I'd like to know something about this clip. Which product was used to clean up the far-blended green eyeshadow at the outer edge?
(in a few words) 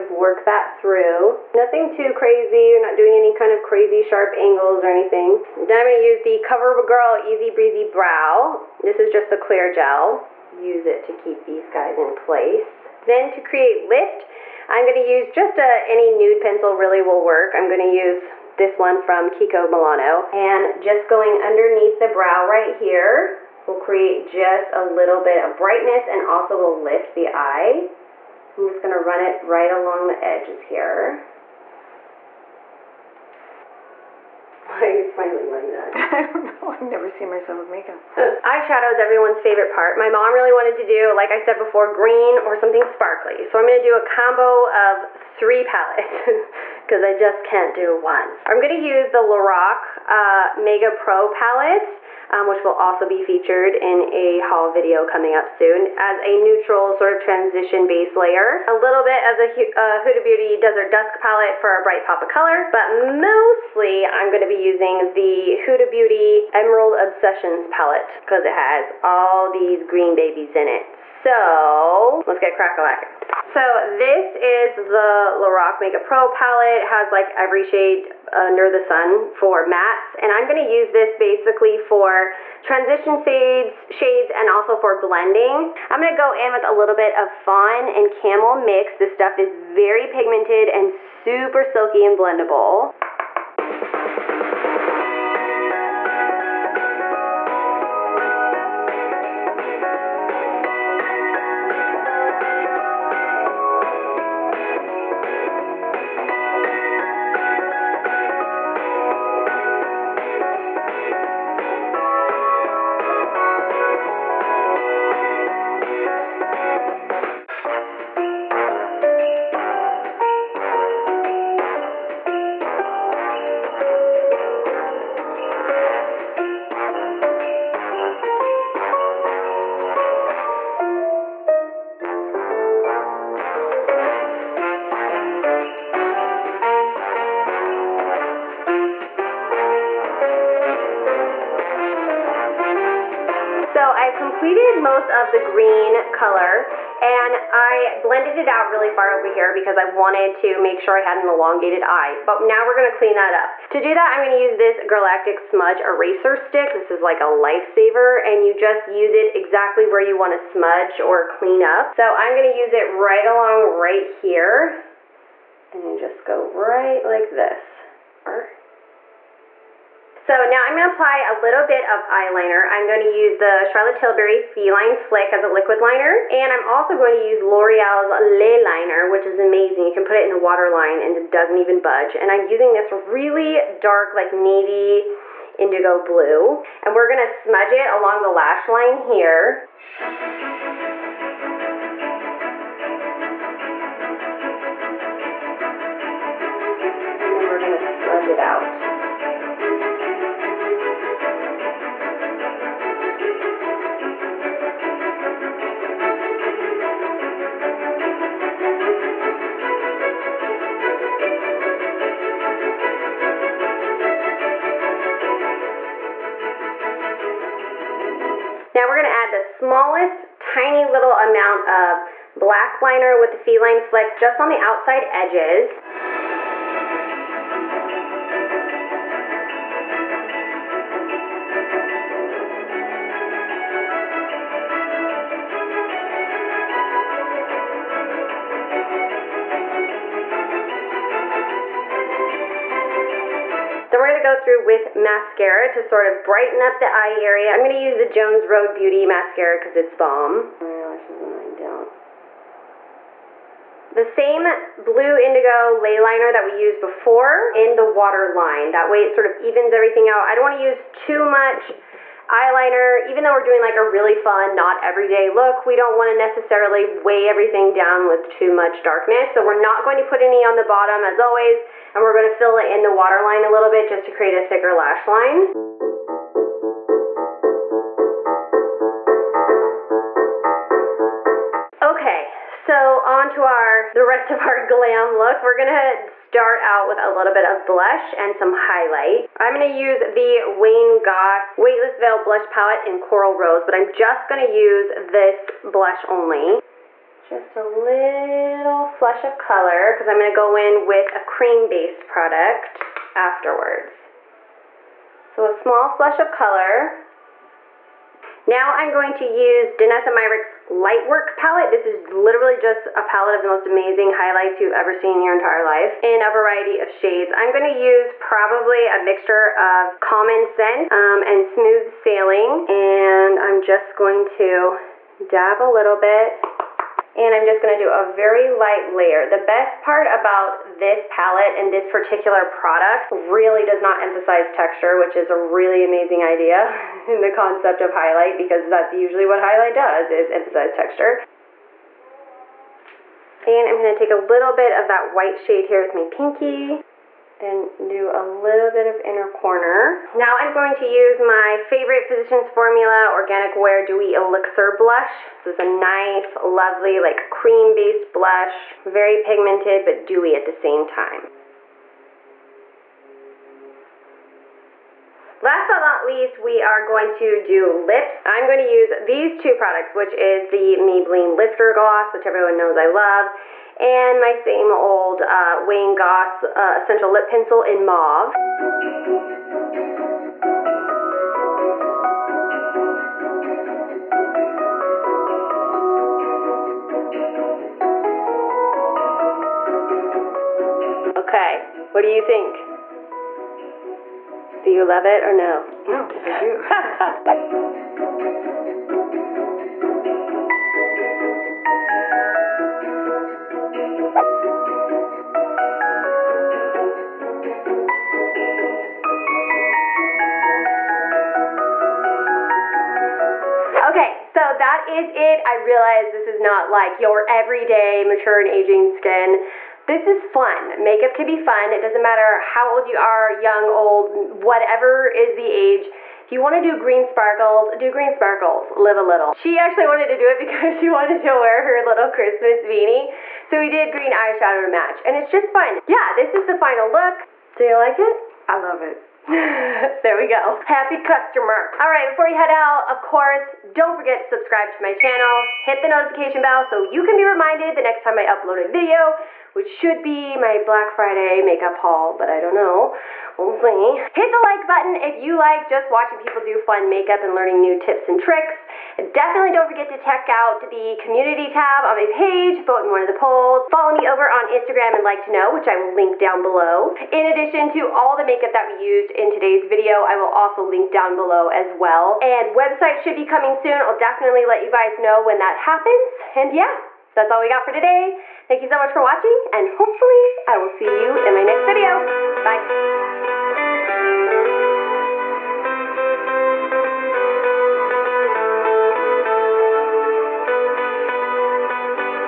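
Galactic Smudge Eraser Stick.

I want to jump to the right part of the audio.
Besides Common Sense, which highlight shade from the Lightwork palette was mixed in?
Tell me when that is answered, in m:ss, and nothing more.
5:21.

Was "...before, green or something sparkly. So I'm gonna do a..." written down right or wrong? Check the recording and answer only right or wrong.
right.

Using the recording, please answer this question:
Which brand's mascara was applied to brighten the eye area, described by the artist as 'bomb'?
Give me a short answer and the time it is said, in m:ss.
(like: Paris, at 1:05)
Jones Road Beauty, at 4:08.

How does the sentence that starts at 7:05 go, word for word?
If you wanna do green sparkles, do green sparkles, live a little.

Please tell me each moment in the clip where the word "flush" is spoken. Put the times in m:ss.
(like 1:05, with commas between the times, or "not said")
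4:58, 5:05.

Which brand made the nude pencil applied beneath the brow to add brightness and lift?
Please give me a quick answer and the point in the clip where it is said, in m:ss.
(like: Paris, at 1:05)
Kiko Milano, at 0:19.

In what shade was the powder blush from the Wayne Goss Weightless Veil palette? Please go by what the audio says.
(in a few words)
Coral Rose.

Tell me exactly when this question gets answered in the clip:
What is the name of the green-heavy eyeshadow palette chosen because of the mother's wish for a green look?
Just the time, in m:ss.
1:06.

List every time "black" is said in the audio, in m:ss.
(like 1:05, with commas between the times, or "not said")
3:42, 7:30.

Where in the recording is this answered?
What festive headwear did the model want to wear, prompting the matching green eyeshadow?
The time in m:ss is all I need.
7:12.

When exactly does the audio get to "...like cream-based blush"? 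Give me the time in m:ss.
5:56.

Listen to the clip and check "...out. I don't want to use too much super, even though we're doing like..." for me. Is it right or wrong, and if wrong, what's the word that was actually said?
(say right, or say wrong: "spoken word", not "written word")
wrong: "eyeliner", not "super".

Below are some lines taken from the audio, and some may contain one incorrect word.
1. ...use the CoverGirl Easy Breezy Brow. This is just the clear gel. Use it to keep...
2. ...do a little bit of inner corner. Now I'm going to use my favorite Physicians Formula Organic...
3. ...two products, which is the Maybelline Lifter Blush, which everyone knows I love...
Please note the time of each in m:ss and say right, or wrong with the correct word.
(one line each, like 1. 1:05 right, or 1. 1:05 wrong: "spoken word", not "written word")
1. 0:06 right
2. 5:47 right
3. 6:09 wrong: "Gloss", not "Blush".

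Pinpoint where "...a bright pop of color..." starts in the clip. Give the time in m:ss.
1:01.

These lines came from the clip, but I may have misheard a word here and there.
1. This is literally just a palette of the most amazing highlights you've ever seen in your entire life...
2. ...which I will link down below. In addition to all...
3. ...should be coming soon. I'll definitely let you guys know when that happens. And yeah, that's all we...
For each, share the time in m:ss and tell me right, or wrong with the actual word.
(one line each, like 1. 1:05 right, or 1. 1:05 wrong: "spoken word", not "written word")
1. 5:11 right
2. 7:45 right
3. 7:53 right.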